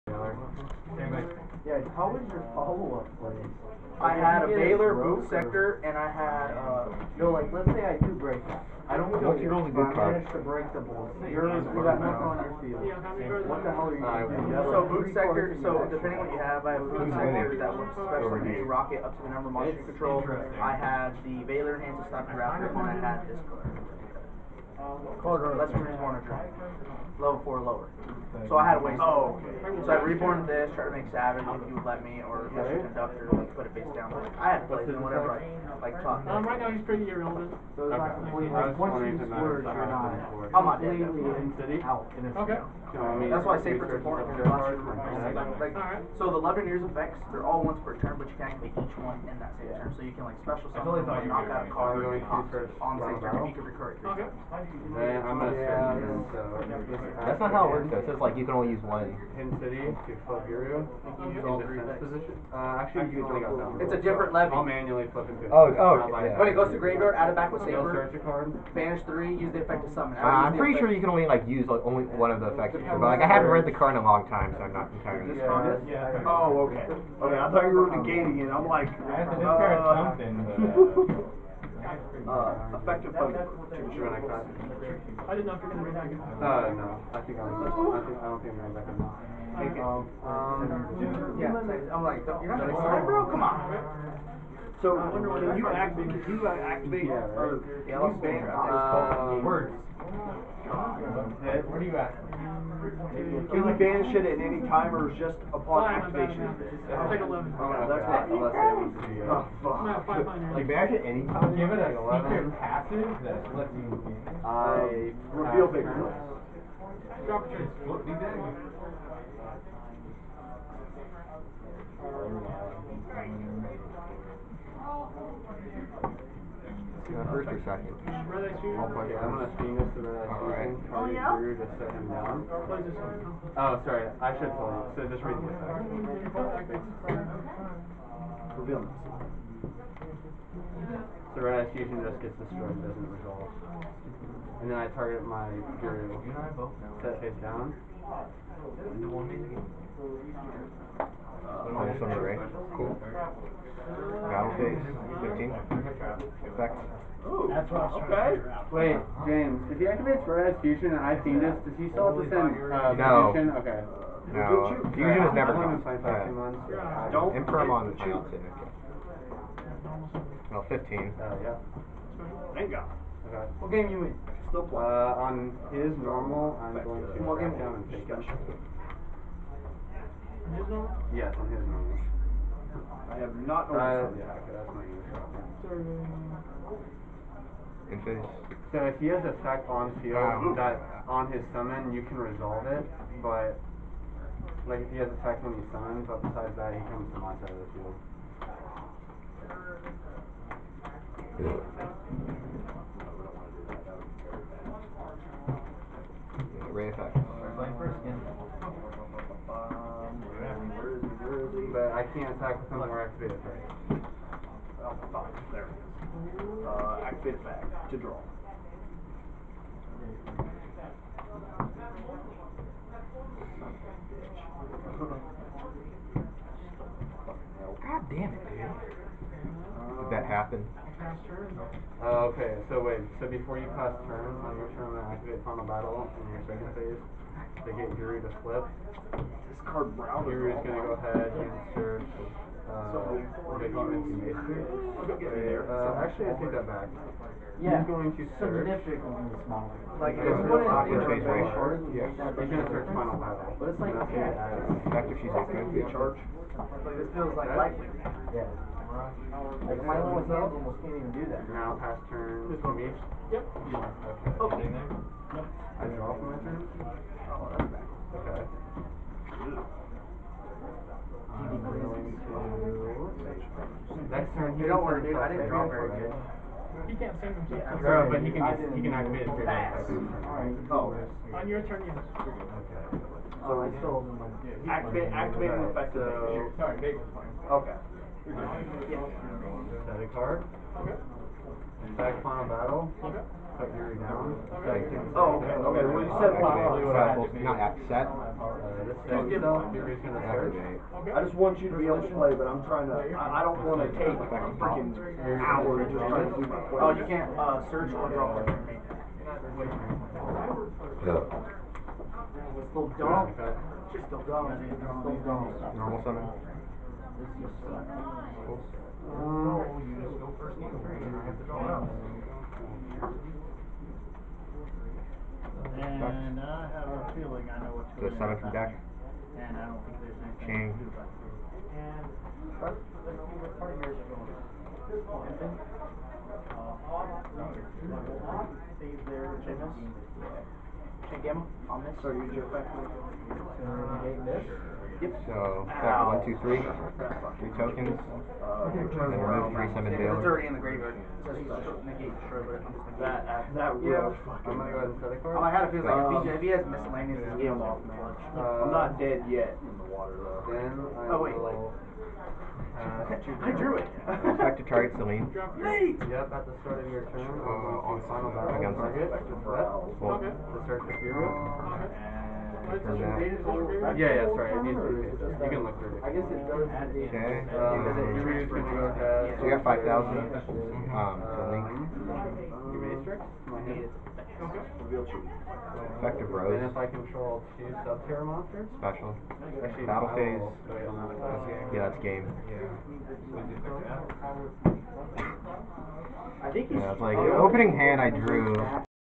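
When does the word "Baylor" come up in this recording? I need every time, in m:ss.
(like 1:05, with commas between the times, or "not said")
0:04, 0:21.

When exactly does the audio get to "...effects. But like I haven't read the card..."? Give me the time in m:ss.
1:12.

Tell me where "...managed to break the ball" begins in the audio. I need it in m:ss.
0:10.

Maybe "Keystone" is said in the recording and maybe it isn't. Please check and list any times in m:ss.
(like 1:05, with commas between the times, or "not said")
not said.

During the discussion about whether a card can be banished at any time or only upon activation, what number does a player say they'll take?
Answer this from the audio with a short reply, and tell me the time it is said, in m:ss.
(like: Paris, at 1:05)
11, at 1:47.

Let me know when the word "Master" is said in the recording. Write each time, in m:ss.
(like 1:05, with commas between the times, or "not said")
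0:32.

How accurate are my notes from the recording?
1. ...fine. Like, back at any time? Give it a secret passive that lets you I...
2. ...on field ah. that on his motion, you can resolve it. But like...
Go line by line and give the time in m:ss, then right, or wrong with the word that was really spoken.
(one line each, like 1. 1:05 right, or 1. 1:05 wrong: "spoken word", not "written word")
1. 1:50 right
2. 3:09 wrong: "summon", not "motion".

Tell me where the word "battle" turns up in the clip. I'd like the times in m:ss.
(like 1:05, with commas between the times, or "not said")
2:34, 3:55, 4:13, 4:52, 6:08, 6:29.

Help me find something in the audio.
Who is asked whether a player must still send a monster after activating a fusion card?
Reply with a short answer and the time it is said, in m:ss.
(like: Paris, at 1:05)
James, at 2:39.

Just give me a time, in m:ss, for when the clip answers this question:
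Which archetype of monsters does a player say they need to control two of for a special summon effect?
6:27.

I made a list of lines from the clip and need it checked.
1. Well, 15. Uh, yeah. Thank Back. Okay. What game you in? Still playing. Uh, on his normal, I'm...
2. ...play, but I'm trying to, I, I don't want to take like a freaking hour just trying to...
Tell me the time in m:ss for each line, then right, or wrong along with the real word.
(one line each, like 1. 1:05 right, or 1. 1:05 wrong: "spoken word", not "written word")
1. 2:50 wrong: "God", not "Back"
2. 5:02 right.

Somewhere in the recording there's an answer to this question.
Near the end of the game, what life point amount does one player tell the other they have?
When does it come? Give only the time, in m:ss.
6:19.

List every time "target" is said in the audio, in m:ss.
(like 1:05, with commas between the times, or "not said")
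2:24, 6:04, 6:08.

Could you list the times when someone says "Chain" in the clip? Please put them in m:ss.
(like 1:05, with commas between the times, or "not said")
5:30.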